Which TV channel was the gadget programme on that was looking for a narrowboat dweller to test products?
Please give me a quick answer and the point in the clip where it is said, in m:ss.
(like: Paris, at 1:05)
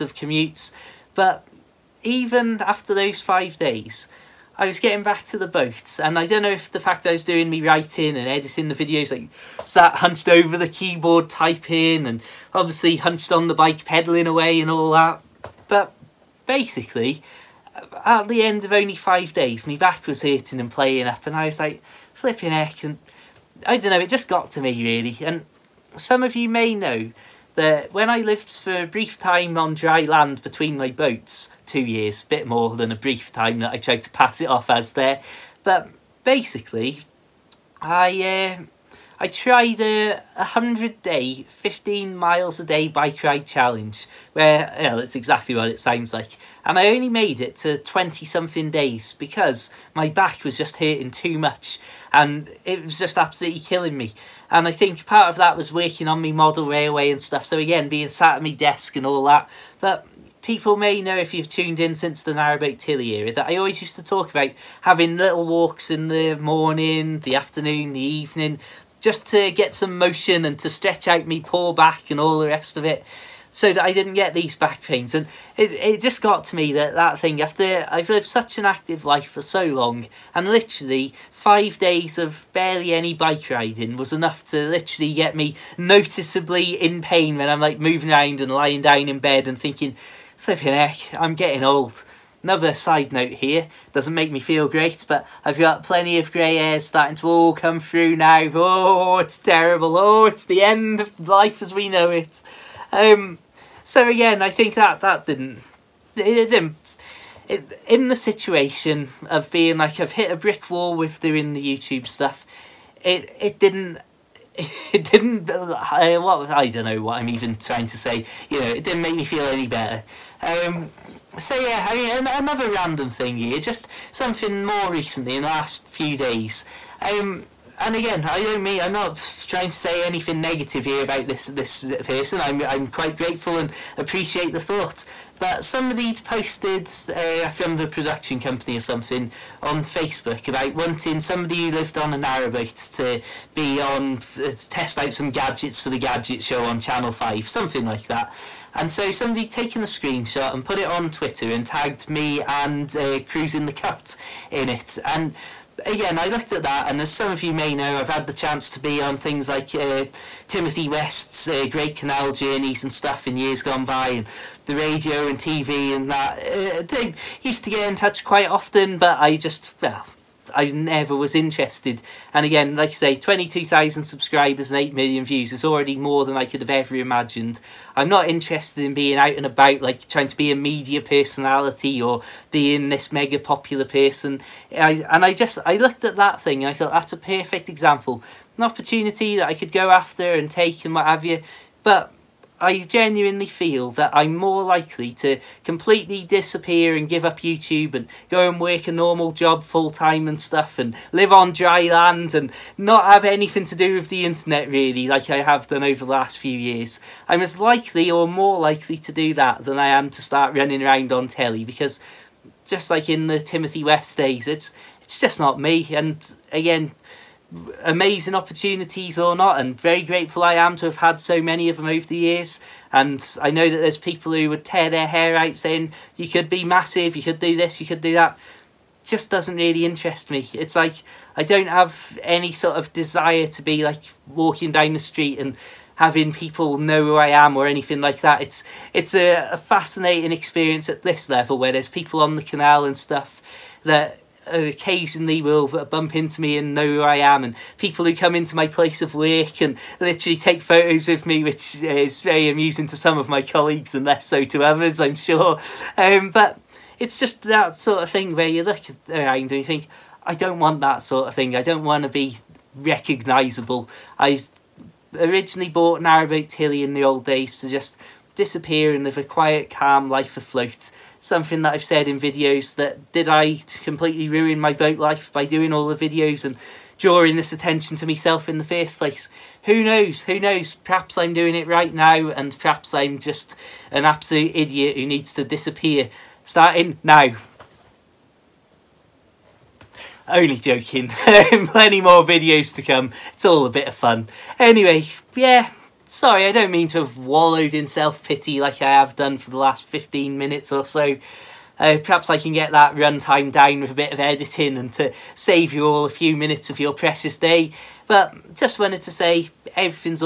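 Channel Five, at 2:26.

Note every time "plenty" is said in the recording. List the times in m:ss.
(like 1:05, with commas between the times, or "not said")
1:35, 4:51.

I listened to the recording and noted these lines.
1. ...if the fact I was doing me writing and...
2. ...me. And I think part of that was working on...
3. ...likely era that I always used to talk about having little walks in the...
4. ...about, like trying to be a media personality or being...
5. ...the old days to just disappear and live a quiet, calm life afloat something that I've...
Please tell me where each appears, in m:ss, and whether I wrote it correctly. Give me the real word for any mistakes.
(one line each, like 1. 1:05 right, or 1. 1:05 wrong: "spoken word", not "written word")
1. 0:06 right
2. 0:53 right
3. 1:02 wrong: "tilly", not "likely"
4. 2:59 right
5. 4:26 right.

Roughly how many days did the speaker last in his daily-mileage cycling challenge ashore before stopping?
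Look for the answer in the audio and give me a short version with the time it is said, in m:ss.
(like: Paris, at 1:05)
20 something, at 0:47.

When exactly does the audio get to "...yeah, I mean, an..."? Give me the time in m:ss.
2:01.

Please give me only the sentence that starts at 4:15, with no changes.
Um, but it's just that sort of thing where you look around and you think, I don't want that sort of thing.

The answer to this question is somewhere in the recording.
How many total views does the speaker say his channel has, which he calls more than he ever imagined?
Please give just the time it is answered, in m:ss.
2:54.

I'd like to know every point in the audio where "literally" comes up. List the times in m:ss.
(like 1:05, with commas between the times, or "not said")
1:20, 1:24, 4:09.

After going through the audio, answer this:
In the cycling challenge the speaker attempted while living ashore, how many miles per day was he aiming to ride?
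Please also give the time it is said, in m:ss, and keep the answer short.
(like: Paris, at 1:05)
15, at 0:41.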